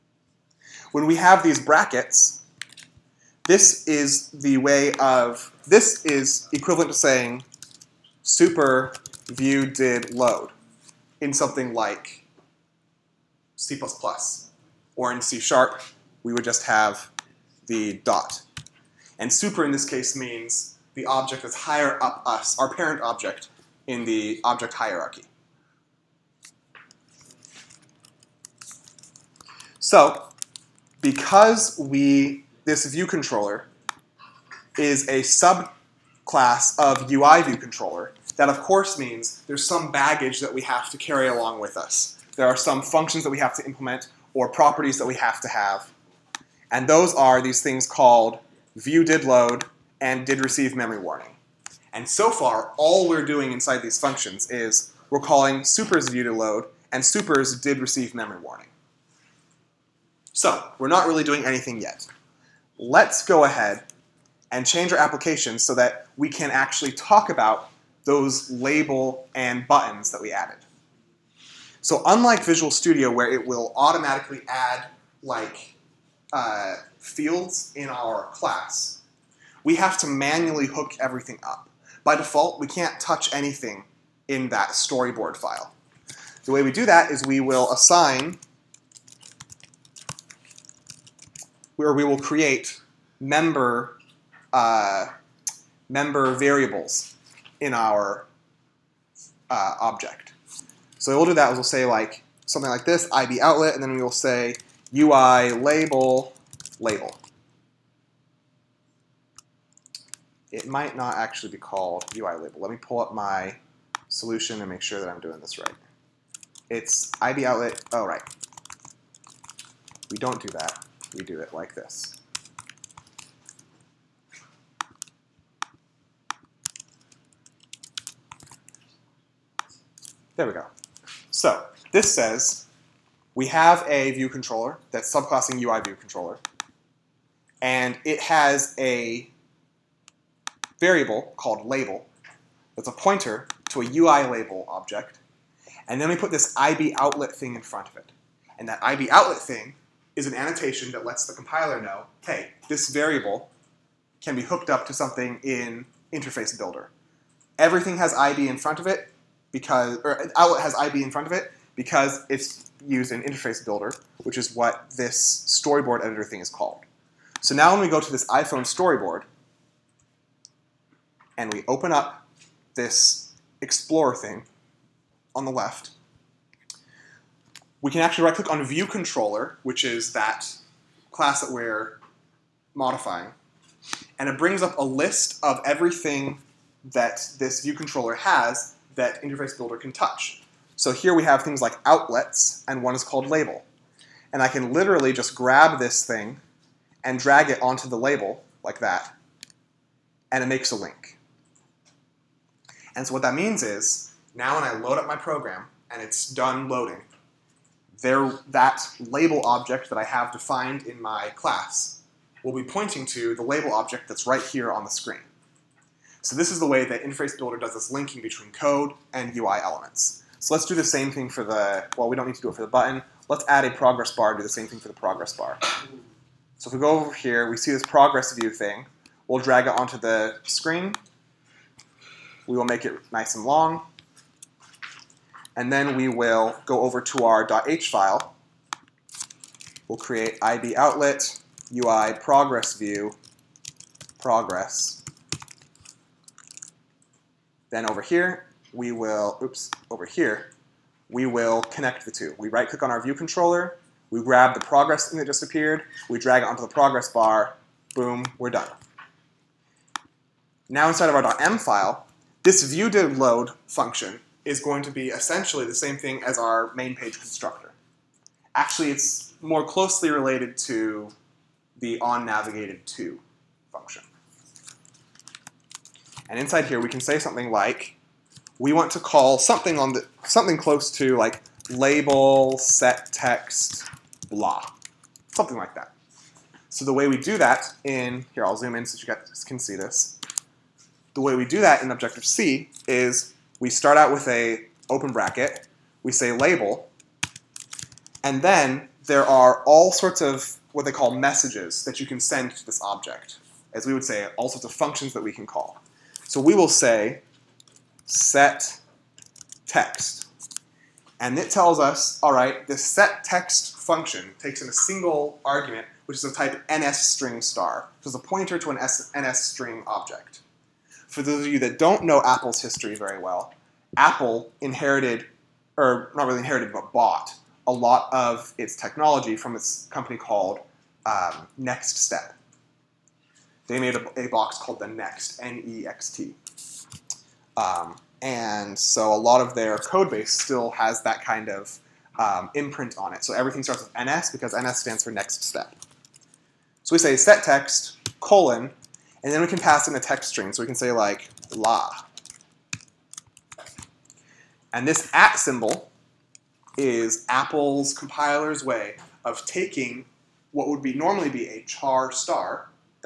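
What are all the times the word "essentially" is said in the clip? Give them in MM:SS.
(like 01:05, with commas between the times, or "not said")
04:25.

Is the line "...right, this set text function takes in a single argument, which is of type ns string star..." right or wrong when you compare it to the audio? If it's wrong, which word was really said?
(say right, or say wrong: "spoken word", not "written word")
right.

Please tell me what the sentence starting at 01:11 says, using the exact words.
So unlike Visual Studio where it will automatically add like uh, fields in our class, we have to manually hook everything up.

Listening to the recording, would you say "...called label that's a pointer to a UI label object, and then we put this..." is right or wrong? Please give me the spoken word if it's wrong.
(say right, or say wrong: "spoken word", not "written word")
right.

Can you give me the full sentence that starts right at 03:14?
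And I can literally just grab this thing and drag it onto the label like that, and it makes a link.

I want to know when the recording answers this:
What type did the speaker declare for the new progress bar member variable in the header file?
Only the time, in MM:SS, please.
04:01.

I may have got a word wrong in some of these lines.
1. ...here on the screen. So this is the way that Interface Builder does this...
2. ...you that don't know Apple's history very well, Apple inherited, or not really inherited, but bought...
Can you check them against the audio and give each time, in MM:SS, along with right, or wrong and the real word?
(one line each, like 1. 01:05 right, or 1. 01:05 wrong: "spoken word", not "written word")
1. 03:34 right
2. 05:21 right.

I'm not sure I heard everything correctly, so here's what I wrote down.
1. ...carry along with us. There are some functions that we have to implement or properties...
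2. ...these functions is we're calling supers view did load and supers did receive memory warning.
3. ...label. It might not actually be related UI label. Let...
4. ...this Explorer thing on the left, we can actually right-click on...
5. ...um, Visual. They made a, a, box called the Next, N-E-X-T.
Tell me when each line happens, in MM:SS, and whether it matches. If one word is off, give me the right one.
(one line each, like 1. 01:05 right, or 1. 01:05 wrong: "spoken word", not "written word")
1. 00:40 right
2. 00:53 right
3. 01:46 wrong: "called", not "related"
4. 02:52 right
5. 05:31 wrong: "NeXTSTEP", not "Visual".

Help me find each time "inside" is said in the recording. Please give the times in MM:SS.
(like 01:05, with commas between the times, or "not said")
00:53, 04:20, 04:36.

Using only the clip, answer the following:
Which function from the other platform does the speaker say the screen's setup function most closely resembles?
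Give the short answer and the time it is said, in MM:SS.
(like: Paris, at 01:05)
onNavigatedTo, at 04:31.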